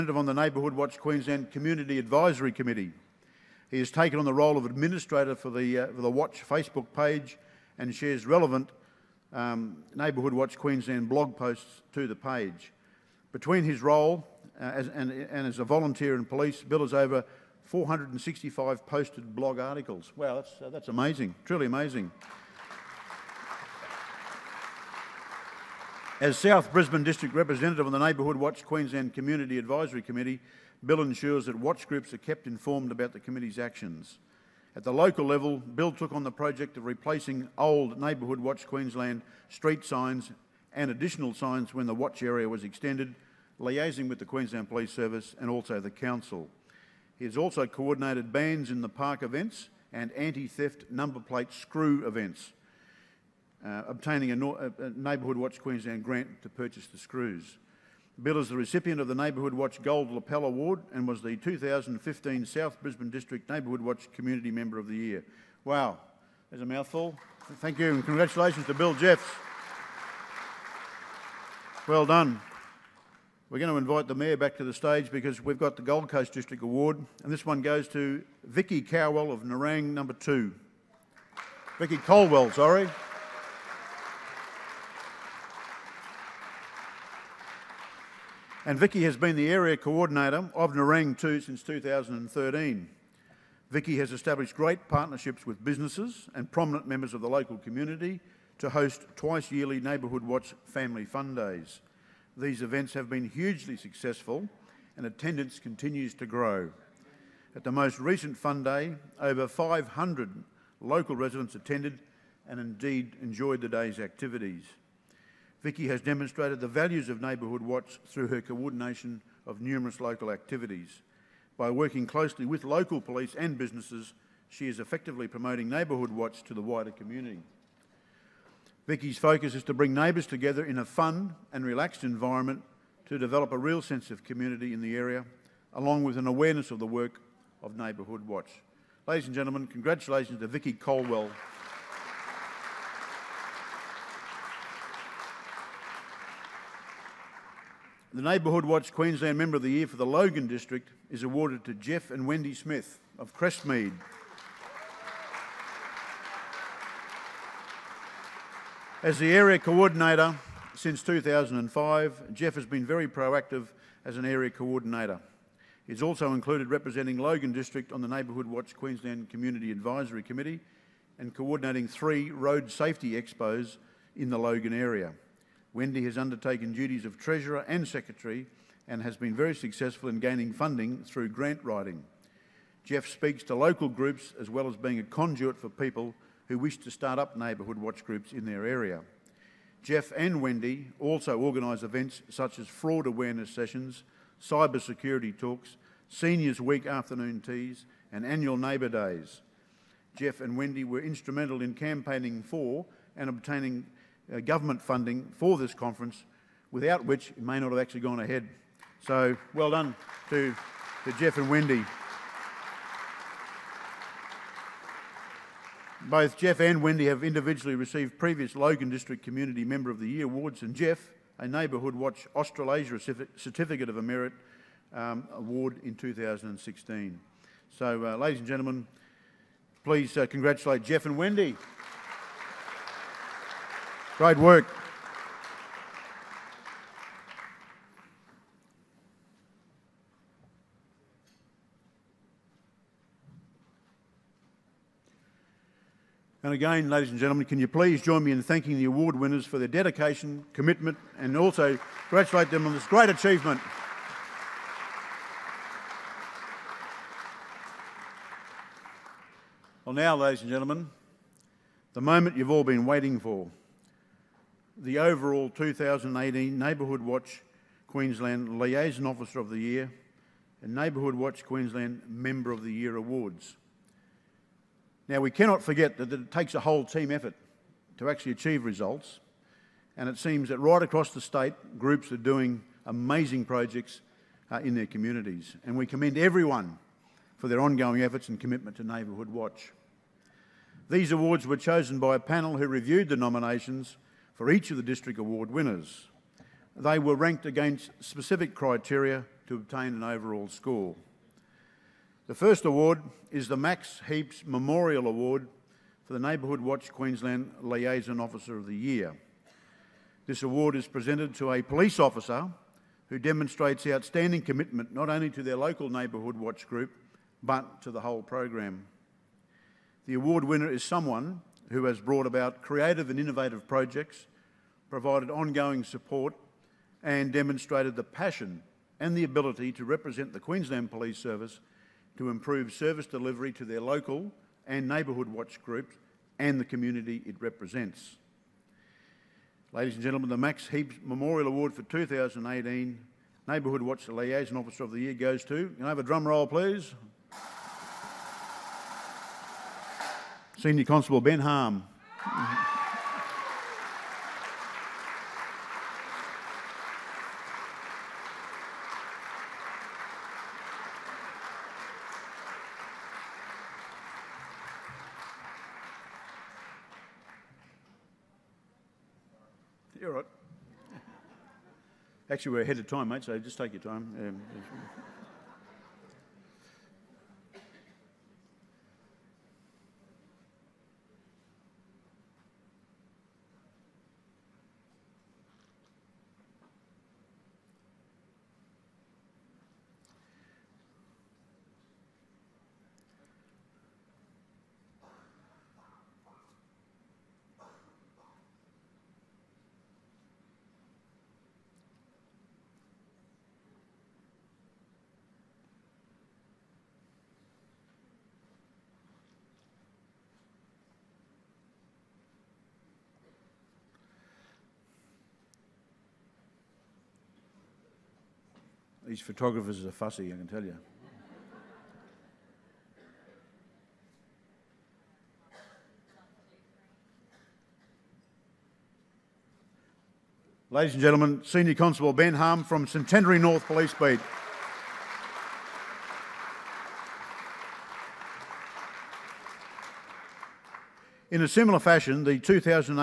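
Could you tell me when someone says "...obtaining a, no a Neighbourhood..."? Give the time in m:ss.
0:53.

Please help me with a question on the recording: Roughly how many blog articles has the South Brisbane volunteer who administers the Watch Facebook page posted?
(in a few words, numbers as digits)
465.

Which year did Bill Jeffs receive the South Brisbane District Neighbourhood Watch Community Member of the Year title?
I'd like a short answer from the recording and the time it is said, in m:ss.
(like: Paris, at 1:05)
2015, at 1:01.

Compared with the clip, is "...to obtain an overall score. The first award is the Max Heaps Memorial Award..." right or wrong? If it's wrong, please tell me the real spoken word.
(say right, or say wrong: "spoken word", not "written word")
right.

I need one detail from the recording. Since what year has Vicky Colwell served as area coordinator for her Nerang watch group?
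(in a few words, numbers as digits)
2013.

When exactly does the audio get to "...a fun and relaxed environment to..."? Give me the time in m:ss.
2:10.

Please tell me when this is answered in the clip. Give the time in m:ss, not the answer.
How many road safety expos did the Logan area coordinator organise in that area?
2:51.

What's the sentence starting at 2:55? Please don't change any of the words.
Wendy has undertaken duties of Treasurer and Secretary and has been very successful in gaining funding through grant writing.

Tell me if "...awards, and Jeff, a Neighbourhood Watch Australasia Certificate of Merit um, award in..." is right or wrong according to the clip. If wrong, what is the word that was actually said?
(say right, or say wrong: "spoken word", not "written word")
right.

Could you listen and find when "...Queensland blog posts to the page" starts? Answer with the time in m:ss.
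0:10.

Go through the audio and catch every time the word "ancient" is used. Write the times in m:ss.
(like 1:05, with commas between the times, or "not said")
not said.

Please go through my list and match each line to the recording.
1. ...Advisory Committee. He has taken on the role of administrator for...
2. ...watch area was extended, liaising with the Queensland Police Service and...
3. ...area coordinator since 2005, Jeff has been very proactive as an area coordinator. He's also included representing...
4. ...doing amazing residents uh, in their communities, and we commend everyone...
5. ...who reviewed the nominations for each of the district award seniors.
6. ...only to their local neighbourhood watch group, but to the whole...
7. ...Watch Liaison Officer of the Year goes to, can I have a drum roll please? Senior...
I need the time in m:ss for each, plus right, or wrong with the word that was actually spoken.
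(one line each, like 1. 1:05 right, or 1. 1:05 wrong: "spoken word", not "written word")
1. 0:01 right
2. 0:41 right
3. 2:39 right
4. 4:42 wrong: "projects", not "residents"
5. 4:52 wrong: "winners", not "seniors"
6. 5:15 right
7. 5:43 right.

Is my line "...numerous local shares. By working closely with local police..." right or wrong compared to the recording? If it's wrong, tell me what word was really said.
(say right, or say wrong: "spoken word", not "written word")
wrong: "activities", not "shares".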